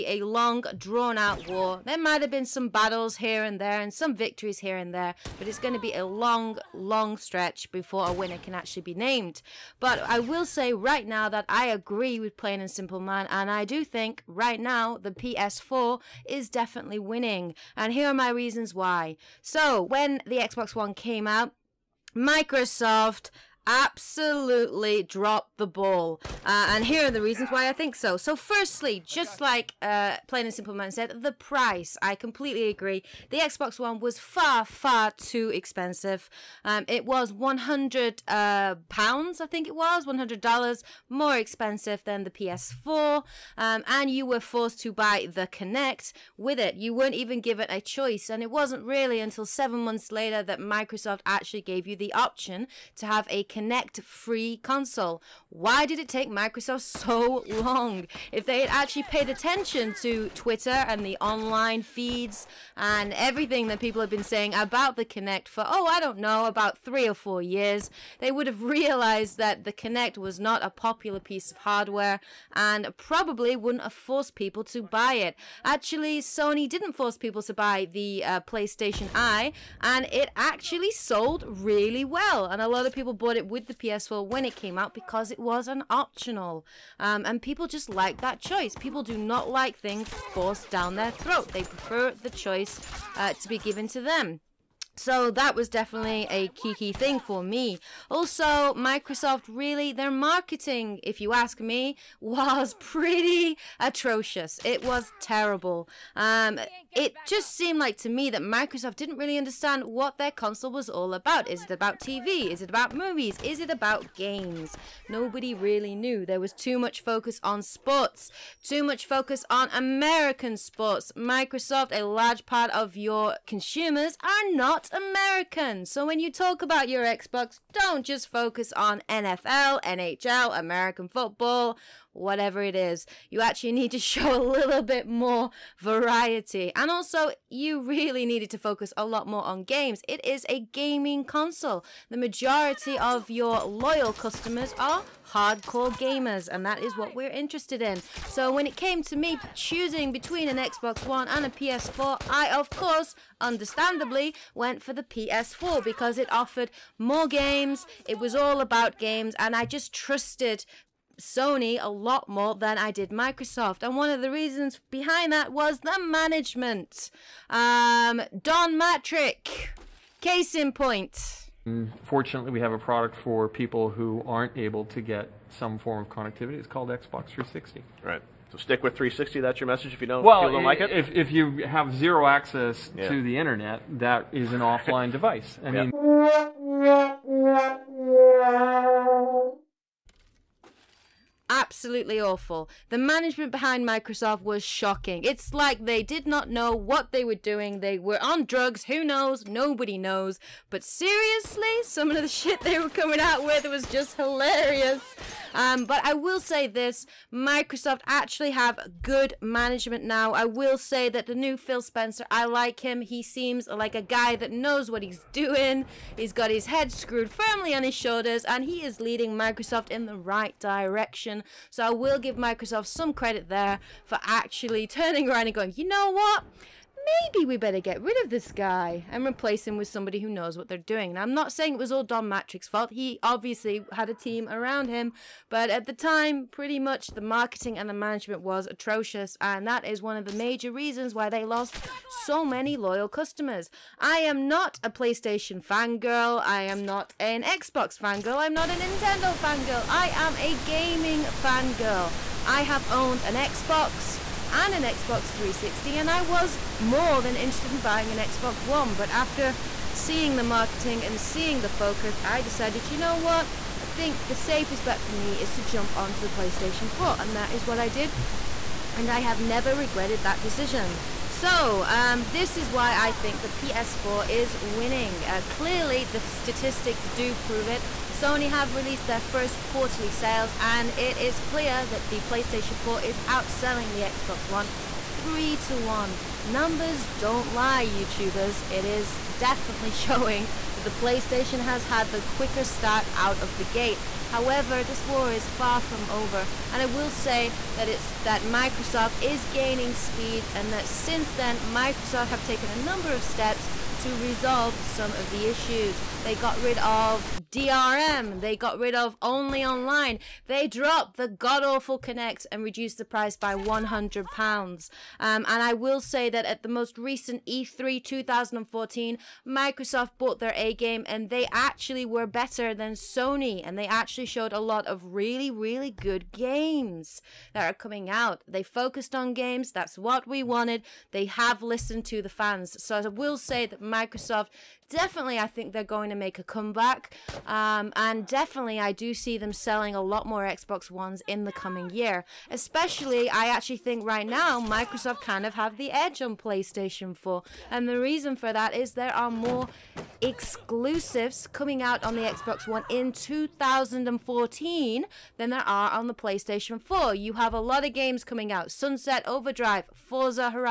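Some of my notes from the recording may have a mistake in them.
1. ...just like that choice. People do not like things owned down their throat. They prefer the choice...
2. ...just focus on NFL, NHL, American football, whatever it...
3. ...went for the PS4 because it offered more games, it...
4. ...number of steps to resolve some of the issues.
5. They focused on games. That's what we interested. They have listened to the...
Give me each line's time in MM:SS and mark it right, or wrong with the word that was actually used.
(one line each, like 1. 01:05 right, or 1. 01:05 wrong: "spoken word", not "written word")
1. 01:27 wrong: "forced", not "owned"
2. 02:08 right
3. 02:34 right
4. 05:02 right
5. 05:28 wrong: "wanted", not "interested".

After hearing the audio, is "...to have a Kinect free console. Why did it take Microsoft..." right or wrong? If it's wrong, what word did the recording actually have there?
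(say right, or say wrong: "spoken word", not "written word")
right.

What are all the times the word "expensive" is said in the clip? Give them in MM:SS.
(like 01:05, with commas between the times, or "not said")
00:35, 00:41.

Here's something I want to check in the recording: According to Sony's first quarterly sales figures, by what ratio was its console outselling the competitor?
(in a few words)
3 to 1.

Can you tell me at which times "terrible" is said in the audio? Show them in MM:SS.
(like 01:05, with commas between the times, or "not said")
01:45.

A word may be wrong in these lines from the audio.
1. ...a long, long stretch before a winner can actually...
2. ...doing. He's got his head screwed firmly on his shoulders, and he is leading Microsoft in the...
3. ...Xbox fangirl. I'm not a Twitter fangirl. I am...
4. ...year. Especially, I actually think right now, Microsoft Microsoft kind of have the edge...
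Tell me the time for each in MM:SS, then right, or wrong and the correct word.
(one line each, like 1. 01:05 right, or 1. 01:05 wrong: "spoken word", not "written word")
1. 00:05 right
2. 03:35 right
3. 04:07 wrong: "Nintendo", not "Twitter"
4. 05:41 right.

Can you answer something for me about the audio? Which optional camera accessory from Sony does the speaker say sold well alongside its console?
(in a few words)
PlayStation Eye.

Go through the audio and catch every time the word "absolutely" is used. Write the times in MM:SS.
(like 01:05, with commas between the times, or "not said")
00:23, 03:11.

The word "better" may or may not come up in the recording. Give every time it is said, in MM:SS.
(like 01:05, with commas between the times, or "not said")
03:47, 05:22.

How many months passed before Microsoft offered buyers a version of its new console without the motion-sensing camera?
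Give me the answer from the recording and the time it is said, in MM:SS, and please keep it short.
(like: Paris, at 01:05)
7, at 00:49.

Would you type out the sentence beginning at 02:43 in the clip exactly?
And one of the reasons behind that was the management.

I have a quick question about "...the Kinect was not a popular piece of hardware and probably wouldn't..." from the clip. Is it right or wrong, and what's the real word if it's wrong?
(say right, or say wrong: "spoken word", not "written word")
right.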